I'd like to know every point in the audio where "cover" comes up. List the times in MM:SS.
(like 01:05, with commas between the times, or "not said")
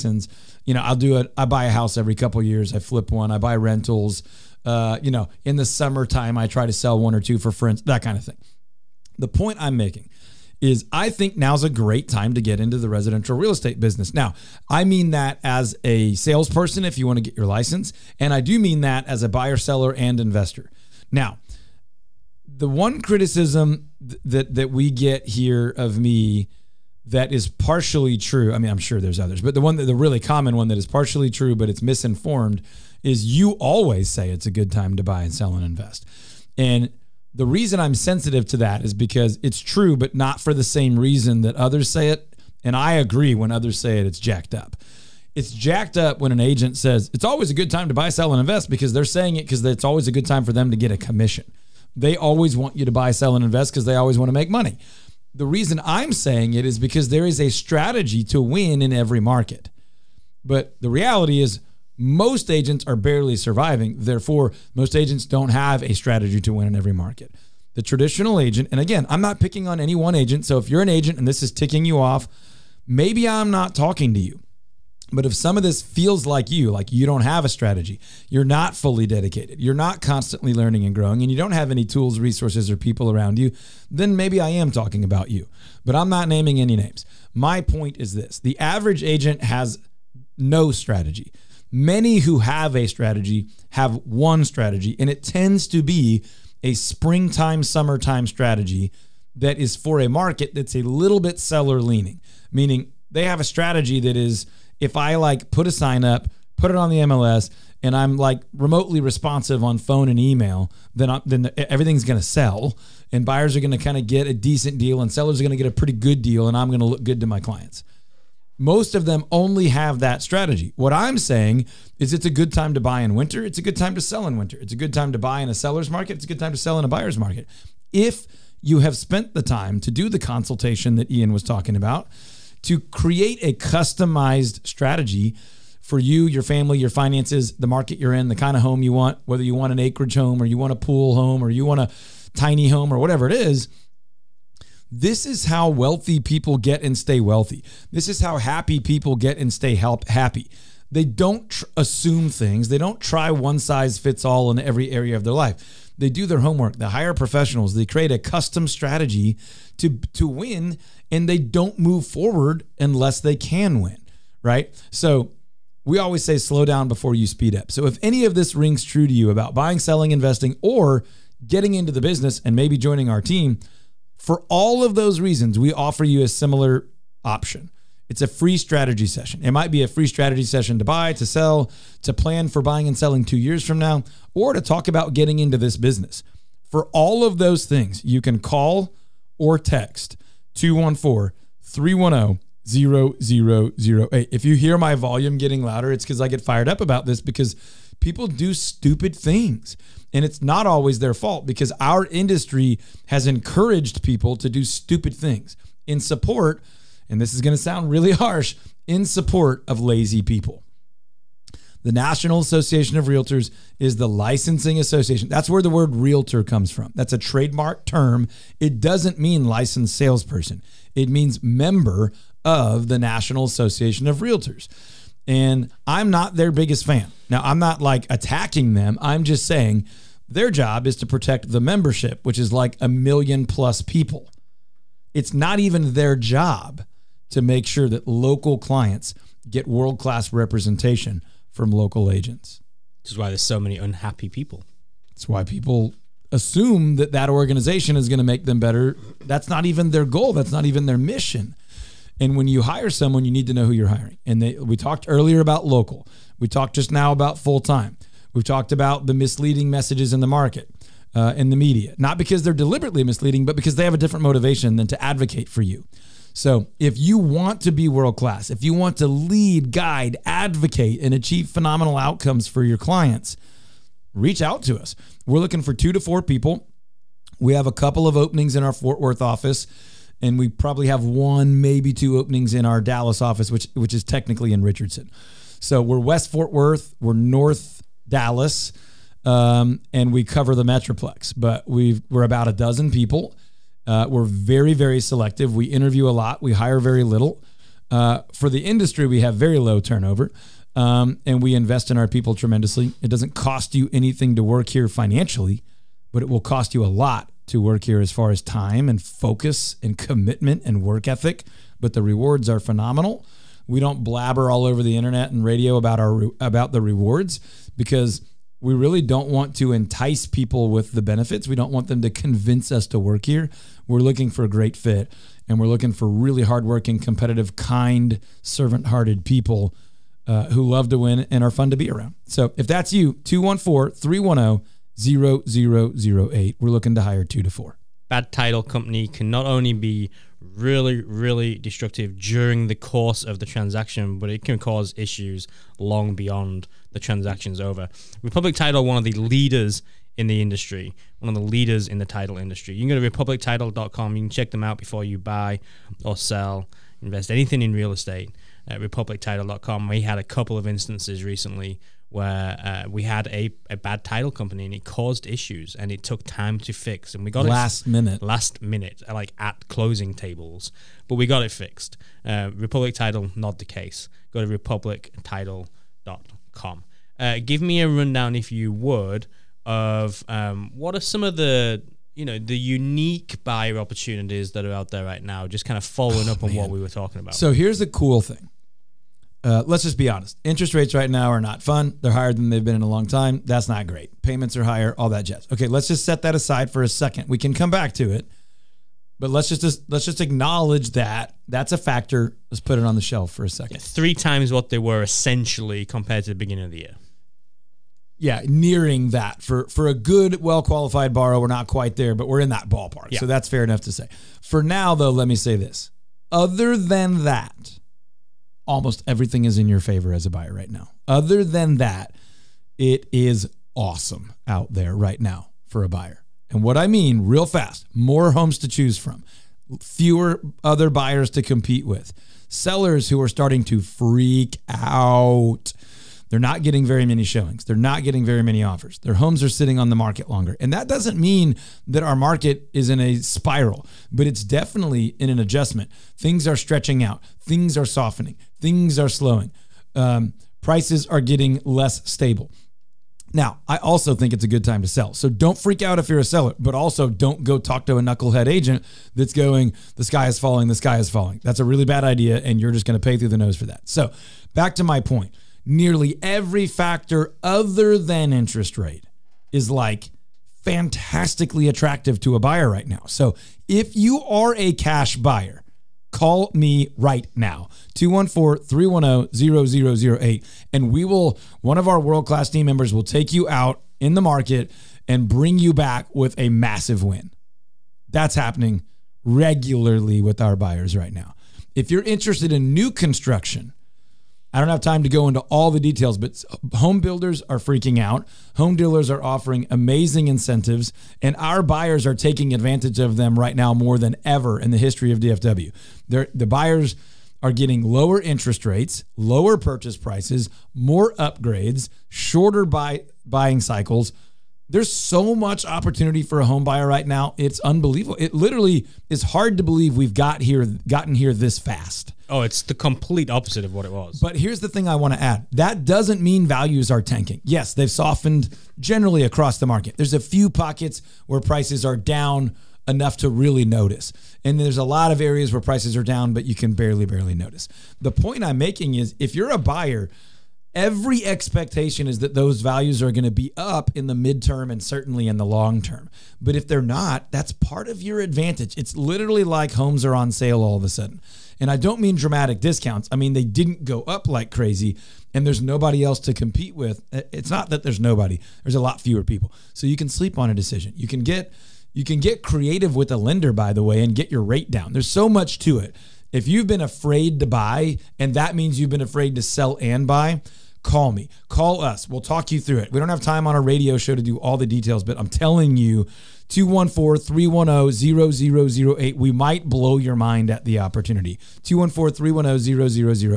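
04:50.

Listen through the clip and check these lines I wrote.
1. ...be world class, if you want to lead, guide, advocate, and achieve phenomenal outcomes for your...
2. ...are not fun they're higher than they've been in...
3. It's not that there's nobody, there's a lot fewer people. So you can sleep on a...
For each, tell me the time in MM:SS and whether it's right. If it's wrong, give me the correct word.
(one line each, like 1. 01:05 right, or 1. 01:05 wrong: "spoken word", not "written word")
1. 04:27 right
2. 06:31 right
3. 09:17 right.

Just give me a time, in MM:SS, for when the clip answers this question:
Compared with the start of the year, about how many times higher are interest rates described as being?
06:43.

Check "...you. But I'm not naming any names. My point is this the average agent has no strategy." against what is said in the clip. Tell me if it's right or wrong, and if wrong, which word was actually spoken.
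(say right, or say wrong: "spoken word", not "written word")
right.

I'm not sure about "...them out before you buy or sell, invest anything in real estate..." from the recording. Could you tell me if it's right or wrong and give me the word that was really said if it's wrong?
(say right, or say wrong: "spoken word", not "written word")
right.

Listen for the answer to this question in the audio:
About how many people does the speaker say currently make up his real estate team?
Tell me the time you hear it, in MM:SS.
04:52.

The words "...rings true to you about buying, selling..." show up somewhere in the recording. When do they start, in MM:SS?
02:48.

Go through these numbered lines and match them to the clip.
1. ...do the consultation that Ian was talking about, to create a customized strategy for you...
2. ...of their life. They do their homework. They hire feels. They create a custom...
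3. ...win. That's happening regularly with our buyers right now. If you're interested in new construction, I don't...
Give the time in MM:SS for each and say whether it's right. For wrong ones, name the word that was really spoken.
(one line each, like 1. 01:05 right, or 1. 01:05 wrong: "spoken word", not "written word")
1. 02:09 right
2. 02:35 wrong: "professionals", not "feels"
3. 08:07 right.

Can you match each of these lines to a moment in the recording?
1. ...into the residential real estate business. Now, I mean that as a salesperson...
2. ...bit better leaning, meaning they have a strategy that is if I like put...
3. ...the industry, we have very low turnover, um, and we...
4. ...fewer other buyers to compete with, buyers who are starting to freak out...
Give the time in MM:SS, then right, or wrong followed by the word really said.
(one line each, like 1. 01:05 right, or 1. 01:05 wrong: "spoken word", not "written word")
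1. 00:12 right
2. 01:41 wrong: "seller", not "better"
3. 04:58 right
4. 07:09 wrong: "sellers", not "buyers".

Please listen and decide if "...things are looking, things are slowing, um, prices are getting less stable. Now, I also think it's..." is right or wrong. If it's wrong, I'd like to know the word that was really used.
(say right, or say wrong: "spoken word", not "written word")
wrong: "softening", not "looking".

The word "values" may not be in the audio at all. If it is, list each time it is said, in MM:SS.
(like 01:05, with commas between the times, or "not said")
08:46, 09:02.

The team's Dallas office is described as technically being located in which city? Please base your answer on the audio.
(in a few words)
Richardson.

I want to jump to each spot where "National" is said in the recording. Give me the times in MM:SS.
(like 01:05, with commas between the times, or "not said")
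03:31, 03:42.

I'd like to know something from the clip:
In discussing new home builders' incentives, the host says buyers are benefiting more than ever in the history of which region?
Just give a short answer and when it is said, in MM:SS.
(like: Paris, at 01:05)
DFW, at 08:25.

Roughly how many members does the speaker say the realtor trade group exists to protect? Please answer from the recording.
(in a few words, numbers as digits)
a million plus.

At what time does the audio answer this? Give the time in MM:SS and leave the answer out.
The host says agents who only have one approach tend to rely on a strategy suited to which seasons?
01:36.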